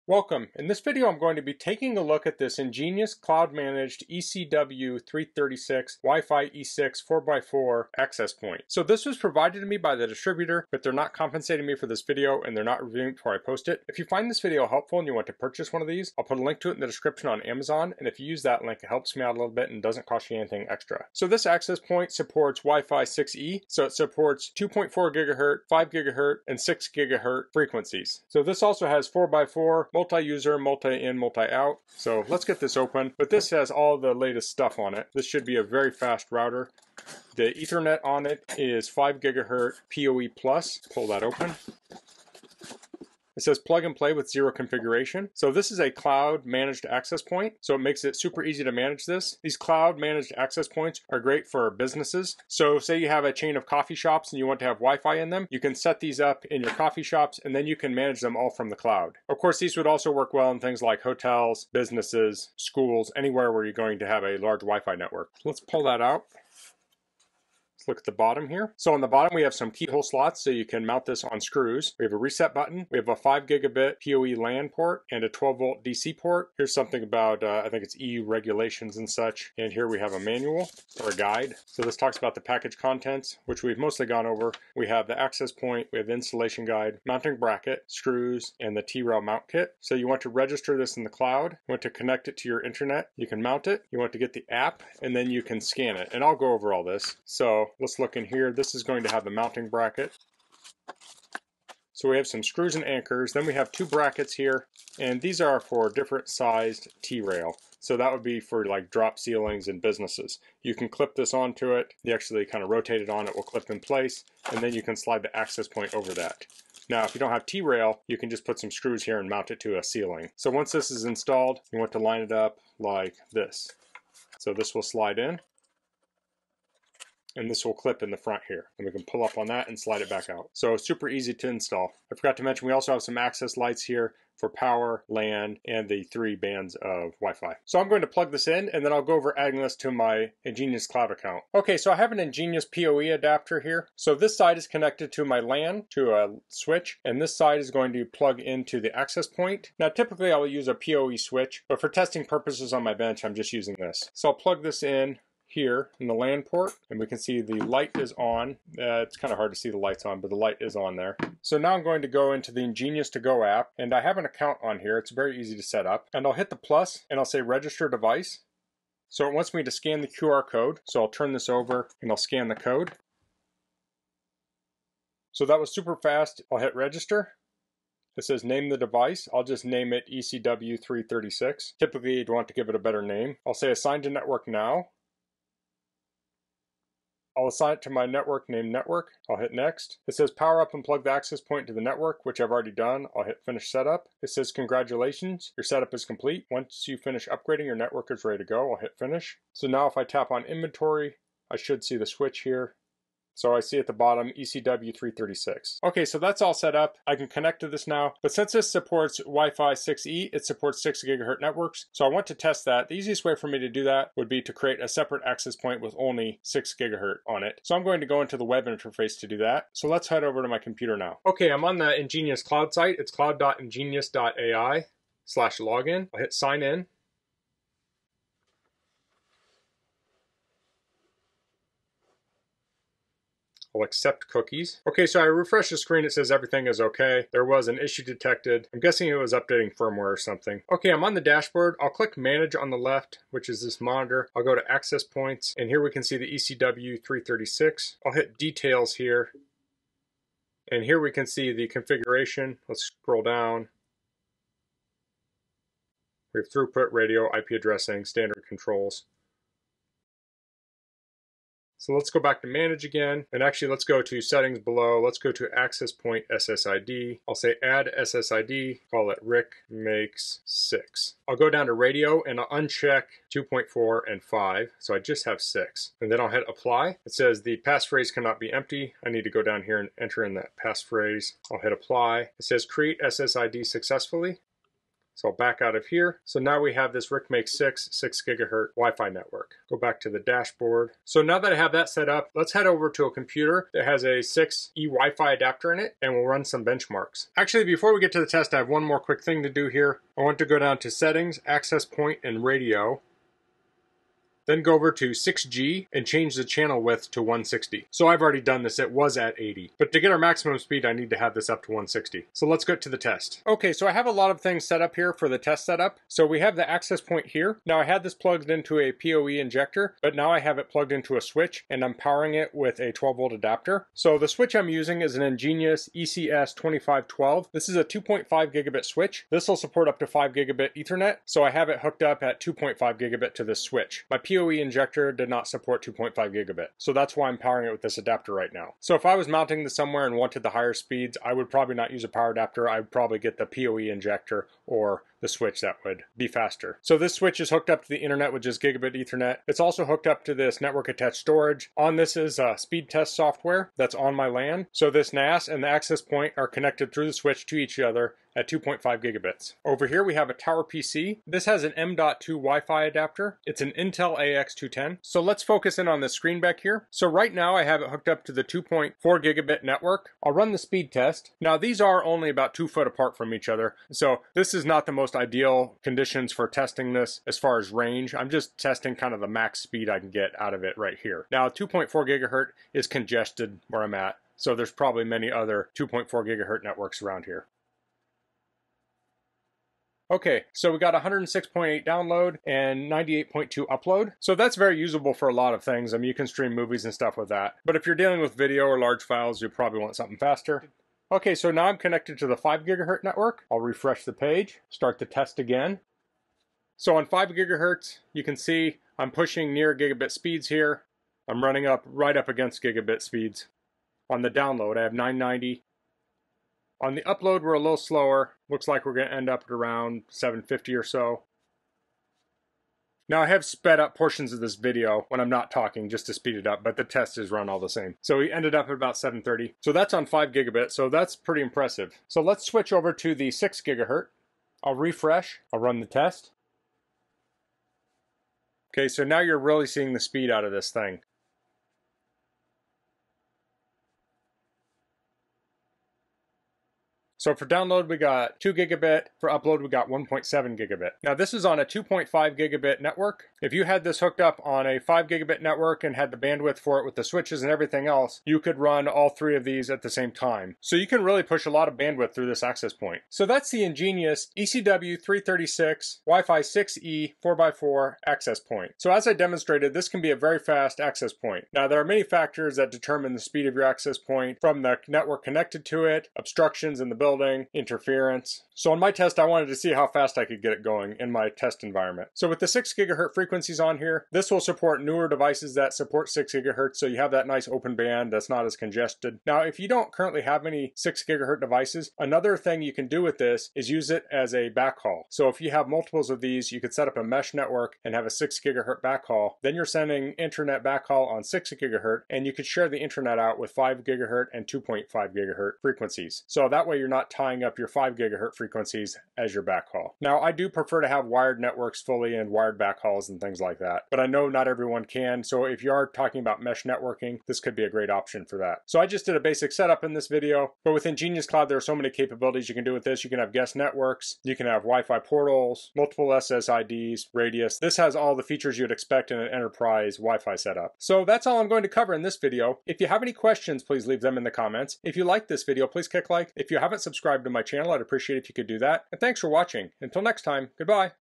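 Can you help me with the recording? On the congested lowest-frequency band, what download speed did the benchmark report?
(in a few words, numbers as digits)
106.8.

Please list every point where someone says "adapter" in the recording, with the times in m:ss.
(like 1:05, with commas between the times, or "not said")
2:23, 4:55, 5:23, 5:37, 5:42, 6:02.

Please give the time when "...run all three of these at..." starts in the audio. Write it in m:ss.
7:38.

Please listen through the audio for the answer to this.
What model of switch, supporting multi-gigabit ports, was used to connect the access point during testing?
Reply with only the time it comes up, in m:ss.
5:25.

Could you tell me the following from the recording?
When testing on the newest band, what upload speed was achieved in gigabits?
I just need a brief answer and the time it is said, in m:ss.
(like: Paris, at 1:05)
1.7 gigabit, at 7:29.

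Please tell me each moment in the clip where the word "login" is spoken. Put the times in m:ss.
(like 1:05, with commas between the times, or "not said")
3:45.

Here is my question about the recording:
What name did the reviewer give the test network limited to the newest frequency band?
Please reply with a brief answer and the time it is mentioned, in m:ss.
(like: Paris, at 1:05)
Rick makes six, at 4:29.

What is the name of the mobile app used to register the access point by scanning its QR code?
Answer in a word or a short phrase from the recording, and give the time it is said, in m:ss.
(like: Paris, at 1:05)
EnGenius to Go, at 2:42.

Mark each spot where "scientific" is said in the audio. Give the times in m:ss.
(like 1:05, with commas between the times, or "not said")
not said.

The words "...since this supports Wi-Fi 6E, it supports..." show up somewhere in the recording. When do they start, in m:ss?
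3:28.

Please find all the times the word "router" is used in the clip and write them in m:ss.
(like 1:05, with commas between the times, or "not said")
0:36.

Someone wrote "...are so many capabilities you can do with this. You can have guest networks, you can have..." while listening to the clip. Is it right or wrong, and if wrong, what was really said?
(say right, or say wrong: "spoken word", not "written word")
right.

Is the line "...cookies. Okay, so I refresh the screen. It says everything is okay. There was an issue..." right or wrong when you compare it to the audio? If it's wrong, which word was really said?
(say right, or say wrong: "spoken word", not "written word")
right.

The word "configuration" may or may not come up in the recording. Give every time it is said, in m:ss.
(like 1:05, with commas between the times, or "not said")
0:44, 4:11.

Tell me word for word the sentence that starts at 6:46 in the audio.
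So on 5 gigahertz, you can see I'm pushing near gigabit speeds here.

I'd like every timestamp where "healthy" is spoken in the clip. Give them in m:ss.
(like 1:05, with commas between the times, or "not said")
not said.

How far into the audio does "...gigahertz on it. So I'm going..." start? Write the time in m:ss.
3:36.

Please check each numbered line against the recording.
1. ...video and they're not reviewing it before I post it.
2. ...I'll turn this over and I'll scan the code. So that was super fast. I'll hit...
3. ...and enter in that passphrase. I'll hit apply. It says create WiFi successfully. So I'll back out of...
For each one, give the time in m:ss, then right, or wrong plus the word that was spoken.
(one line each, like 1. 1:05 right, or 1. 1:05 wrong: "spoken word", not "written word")
1. 0:12 right
2. 2:51 right
3. 4:39 wrong: "SSID", not "WiFi".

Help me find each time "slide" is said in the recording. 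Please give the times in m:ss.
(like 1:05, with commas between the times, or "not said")
1:54, 2:04, 2:09.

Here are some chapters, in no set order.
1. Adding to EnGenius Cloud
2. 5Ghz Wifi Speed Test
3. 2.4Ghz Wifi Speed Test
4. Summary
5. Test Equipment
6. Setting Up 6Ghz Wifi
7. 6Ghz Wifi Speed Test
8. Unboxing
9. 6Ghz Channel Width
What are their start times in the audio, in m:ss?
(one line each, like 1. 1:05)
1. 2:17
2. 6:40
3. 6:04
4. 7:43
5. 5:13
6. 3:41
7. 7:14
8. 0:31
9. 4:57.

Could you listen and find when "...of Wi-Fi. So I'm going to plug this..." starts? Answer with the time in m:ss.
2:16.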